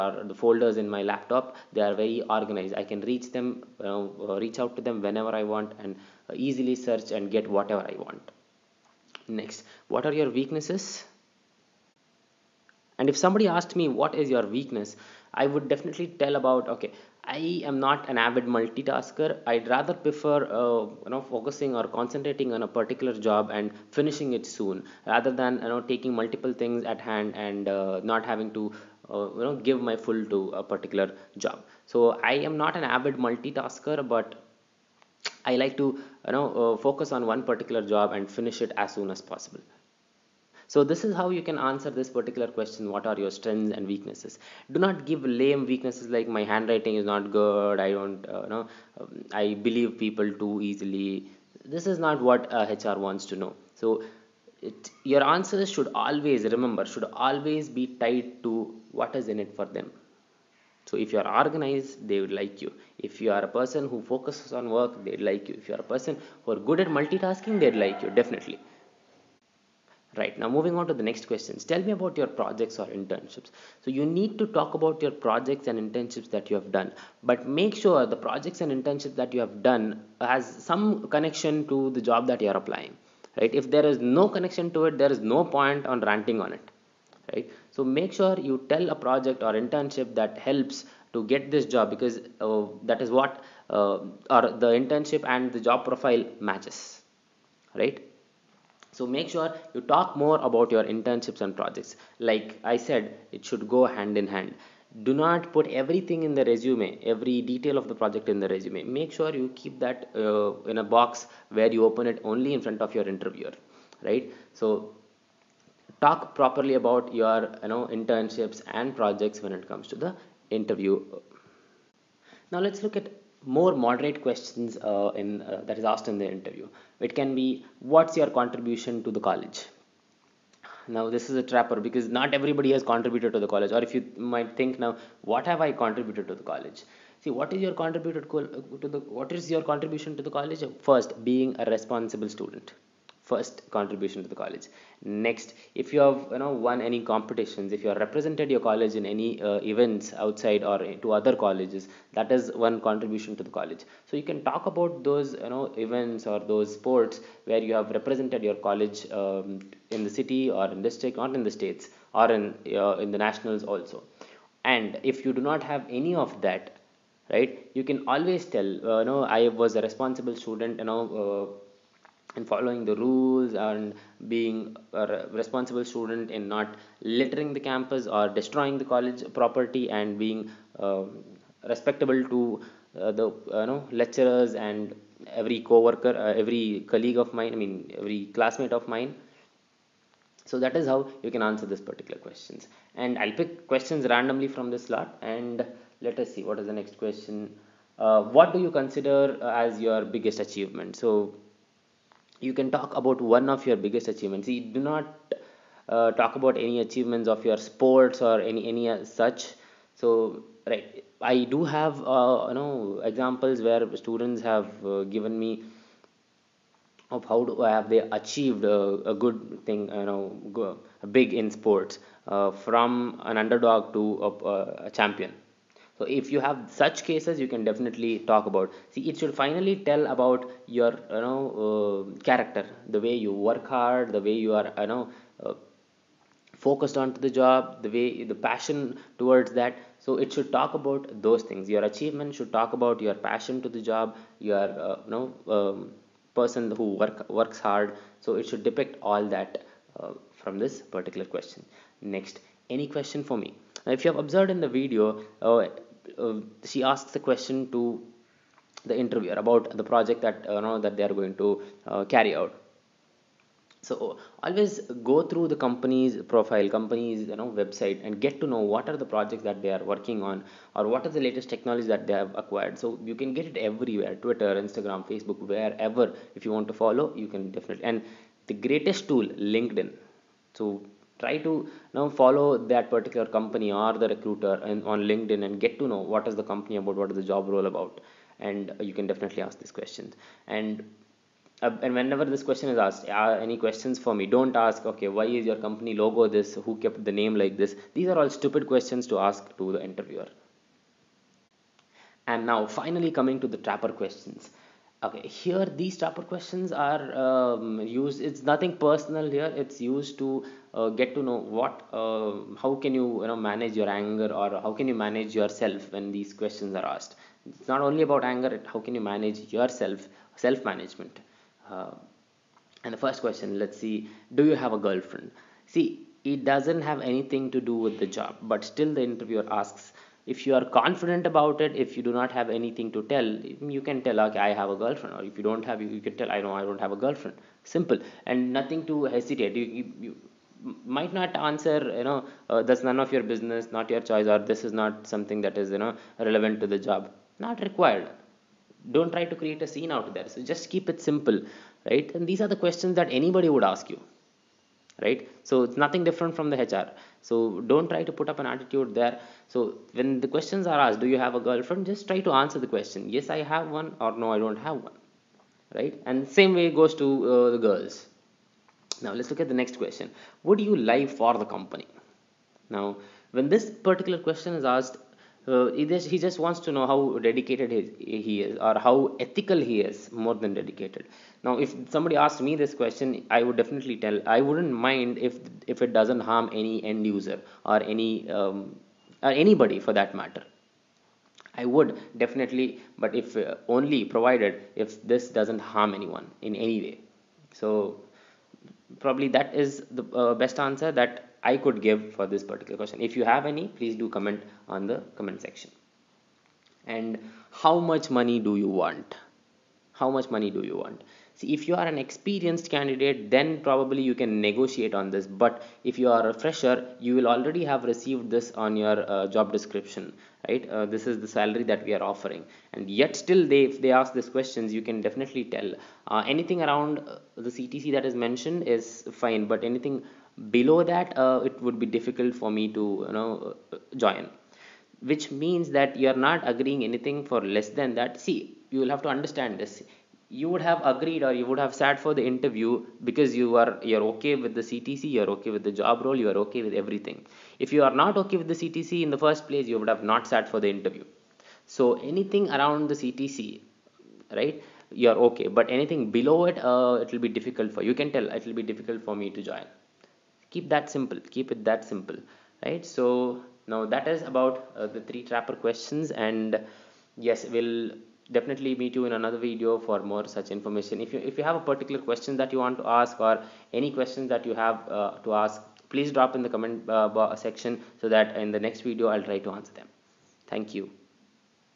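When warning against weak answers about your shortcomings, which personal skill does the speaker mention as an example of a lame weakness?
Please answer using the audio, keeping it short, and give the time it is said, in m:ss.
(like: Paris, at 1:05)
Handwriting, at 0:46.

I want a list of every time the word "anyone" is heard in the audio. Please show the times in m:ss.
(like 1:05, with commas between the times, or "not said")
6:35.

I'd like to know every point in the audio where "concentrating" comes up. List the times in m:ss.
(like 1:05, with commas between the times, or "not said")
0:21.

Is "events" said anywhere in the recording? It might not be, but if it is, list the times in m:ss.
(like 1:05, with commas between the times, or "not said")
2:29, 2:35.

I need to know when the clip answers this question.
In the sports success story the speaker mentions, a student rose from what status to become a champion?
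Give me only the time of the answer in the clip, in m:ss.
3:43.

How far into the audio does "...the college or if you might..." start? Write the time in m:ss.
2:13.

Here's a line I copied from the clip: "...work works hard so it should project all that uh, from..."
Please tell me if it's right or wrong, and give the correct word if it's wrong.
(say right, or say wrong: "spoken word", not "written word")
wrong: "depict", not "project".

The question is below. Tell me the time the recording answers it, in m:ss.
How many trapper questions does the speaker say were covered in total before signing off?
7:45.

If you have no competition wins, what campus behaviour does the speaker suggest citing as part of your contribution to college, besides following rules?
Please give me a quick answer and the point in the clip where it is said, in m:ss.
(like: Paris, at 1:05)
Not littering the campus, at 2:56.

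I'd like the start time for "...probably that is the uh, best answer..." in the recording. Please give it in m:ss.
6:38.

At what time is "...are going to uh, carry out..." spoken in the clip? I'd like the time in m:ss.
4:21.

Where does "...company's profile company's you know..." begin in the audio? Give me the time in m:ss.
4:25.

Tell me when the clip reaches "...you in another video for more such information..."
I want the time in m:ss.
7:48.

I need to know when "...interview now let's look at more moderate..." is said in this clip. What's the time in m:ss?
2:00.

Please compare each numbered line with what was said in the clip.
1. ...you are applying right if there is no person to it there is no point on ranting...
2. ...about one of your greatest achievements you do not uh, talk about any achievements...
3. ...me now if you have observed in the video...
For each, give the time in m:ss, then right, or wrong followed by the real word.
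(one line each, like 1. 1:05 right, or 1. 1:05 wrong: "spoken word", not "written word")
1. 1:22 wrong: "connection", not "person"
2. 3:22 wrong: "biggest", not "greatest"
3. 4:13 right.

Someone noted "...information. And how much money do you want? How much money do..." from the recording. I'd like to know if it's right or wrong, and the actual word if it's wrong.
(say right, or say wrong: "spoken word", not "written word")
wrong: "section", not "information".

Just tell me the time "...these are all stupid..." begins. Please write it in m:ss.
4:57.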